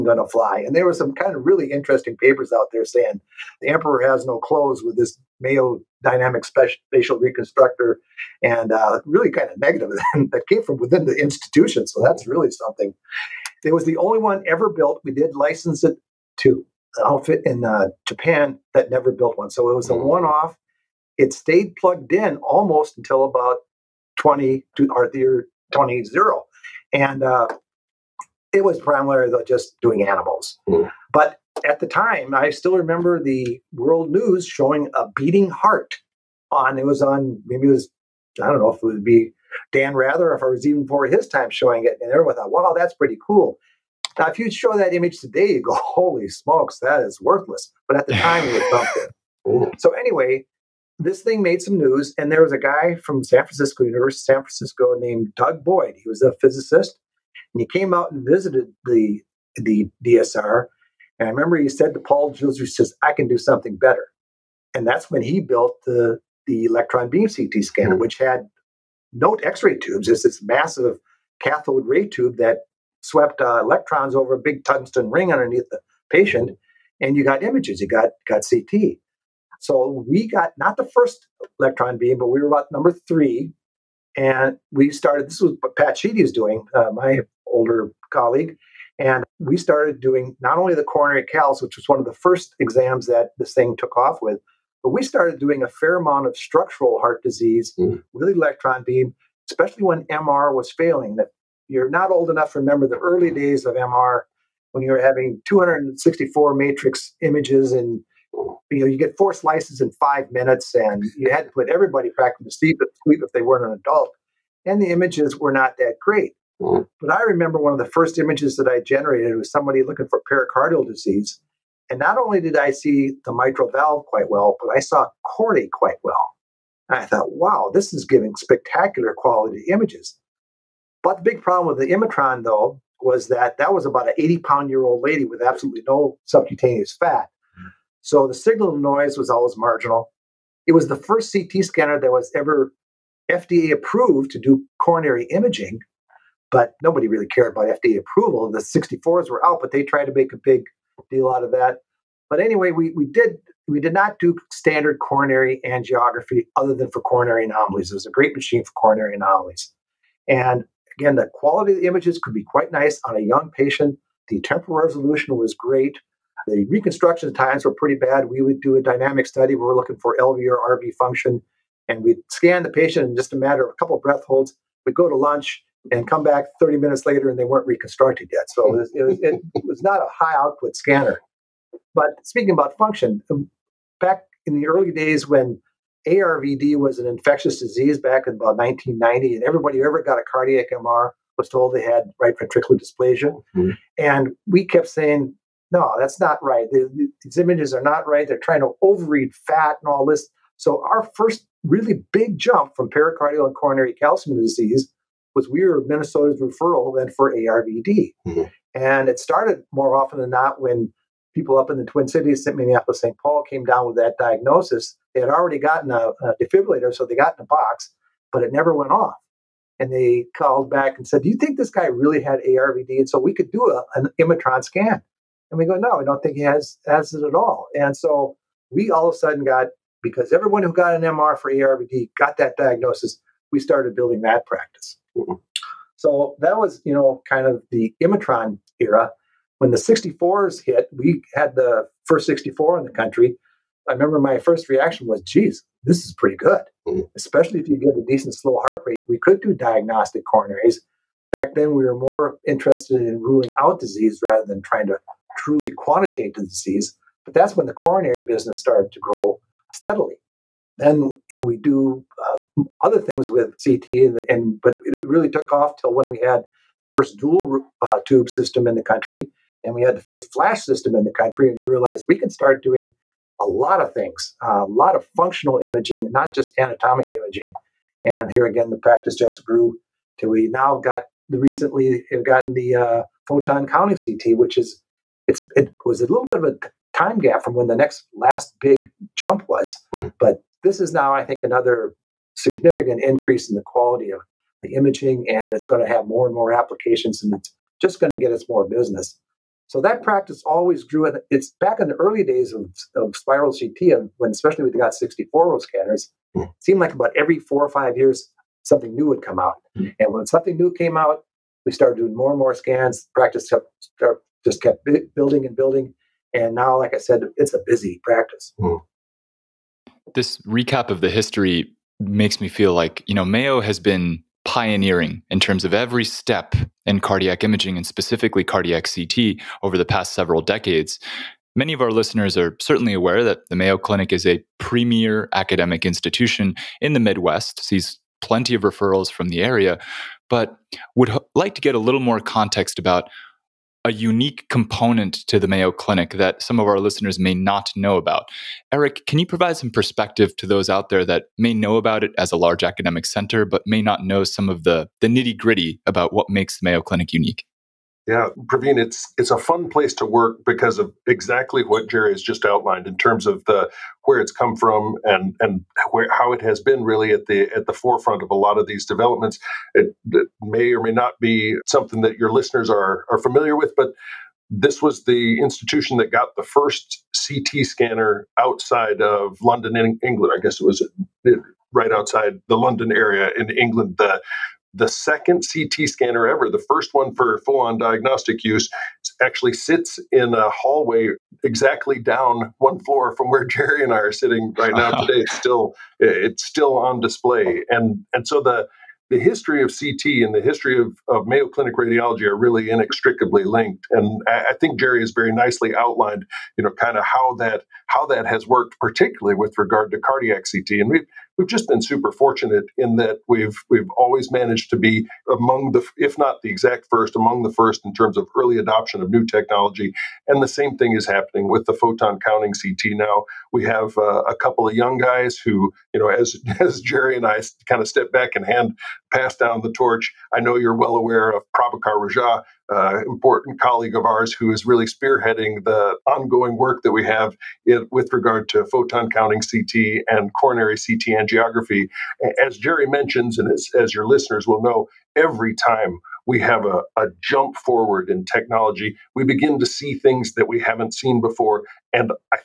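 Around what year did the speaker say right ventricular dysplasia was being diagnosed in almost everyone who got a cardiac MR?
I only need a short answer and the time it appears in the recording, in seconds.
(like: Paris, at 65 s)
1990, at 188 s.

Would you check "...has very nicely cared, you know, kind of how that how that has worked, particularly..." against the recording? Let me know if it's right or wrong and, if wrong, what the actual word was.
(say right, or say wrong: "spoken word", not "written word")
wrong: "outlined", not "cared".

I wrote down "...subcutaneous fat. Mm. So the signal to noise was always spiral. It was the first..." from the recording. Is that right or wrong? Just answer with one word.
wrong.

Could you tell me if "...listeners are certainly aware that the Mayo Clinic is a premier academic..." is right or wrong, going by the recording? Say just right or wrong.
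right.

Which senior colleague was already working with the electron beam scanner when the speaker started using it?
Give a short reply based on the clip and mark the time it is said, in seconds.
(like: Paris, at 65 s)
Pat Sheedy, at 85 s.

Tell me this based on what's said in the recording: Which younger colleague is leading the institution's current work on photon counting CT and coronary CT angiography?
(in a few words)
Prabhakar Rajiah.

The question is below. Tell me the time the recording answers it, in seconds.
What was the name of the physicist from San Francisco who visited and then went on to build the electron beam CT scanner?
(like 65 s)
55 s.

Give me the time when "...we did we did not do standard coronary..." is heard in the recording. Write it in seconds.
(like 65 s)
152 s.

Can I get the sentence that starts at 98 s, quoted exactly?
with electron beam, especially when MR was failing.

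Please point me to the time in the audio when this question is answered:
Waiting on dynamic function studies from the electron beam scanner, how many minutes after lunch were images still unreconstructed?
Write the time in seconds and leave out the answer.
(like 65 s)
176 s.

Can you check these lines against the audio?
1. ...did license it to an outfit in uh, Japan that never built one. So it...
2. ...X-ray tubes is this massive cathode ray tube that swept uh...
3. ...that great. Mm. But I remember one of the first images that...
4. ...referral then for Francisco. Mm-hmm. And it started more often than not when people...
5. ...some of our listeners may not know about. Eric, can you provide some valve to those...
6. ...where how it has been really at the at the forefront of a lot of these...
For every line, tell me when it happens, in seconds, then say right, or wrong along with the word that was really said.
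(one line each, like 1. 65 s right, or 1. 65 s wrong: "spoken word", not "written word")
1. 15 s right
2. 69 s right
3. 115 s right
4. 206 s wrong: "ARVD", not "Francisco"
5. 346 s wrong: "perspective", not "valve"
6. 365 s right.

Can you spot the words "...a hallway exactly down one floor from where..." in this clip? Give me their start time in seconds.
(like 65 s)
390 s.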